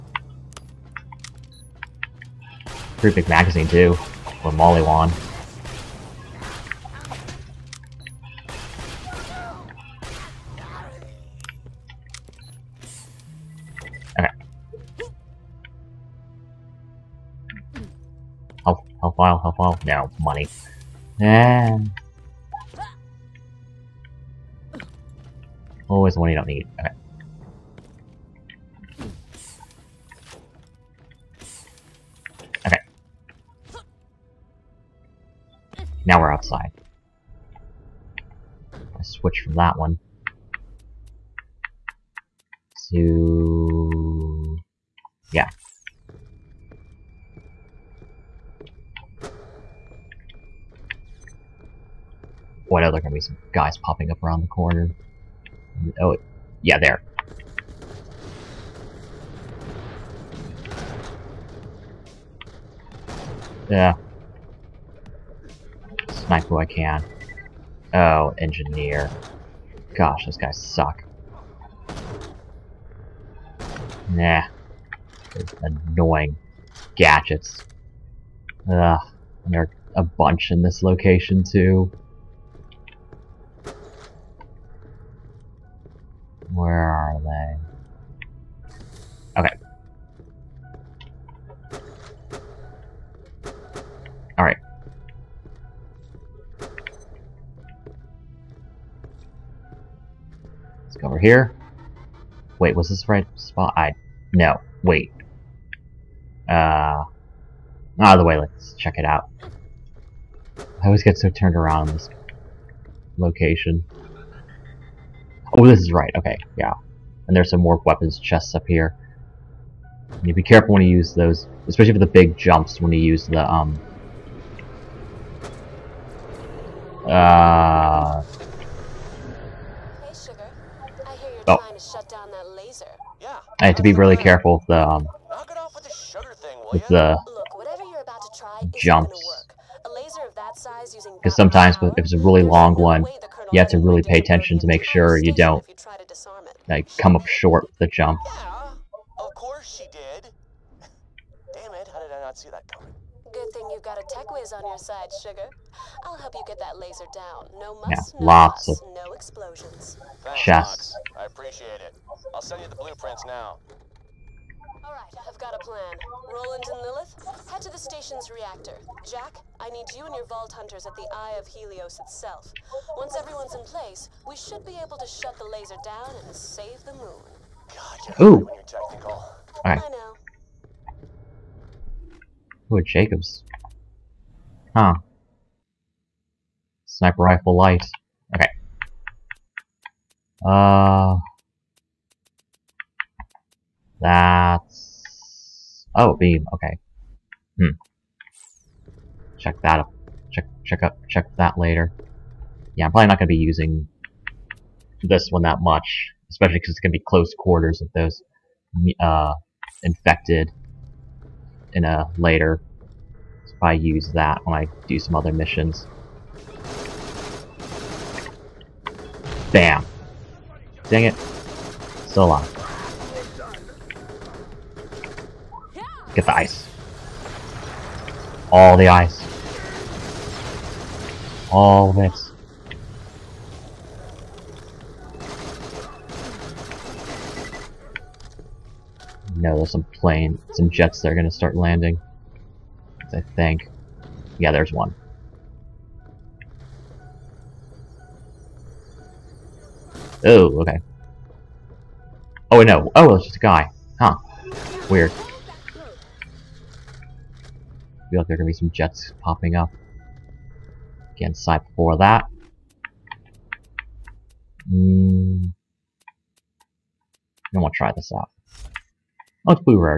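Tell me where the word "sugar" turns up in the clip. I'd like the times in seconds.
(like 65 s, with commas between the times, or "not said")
130 s, 135 s, 155 s.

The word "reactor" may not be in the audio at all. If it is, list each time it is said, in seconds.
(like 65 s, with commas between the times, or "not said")
168 s.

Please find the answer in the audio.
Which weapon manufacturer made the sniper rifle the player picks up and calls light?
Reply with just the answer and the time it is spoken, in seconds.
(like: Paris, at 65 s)
Jakobs, at 182 s.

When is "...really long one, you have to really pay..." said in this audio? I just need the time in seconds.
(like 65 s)
142 s.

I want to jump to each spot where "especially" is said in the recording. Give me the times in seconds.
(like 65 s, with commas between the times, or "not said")
121 s, 206 s.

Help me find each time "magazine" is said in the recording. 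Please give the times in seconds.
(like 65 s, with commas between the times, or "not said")
3 s.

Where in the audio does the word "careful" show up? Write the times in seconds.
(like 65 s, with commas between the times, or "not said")
120 s, 134 s.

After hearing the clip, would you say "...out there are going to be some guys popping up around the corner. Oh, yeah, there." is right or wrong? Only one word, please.
right.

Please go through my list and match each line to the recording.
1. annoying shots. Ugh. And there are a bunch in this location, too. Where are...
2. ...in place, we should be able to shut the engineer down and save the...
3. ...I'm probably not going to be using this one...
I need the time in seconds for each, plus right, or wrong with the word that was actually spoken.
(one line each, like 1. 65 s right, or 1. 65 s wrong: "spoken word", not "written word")
1. 75 s wrong: "gadgets", not "shots"
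2. 173 s wrong: "laser", not "engineer"
3. 202 s right.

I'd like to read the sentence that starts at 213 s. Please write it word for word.
So if I use that when I do some other missions.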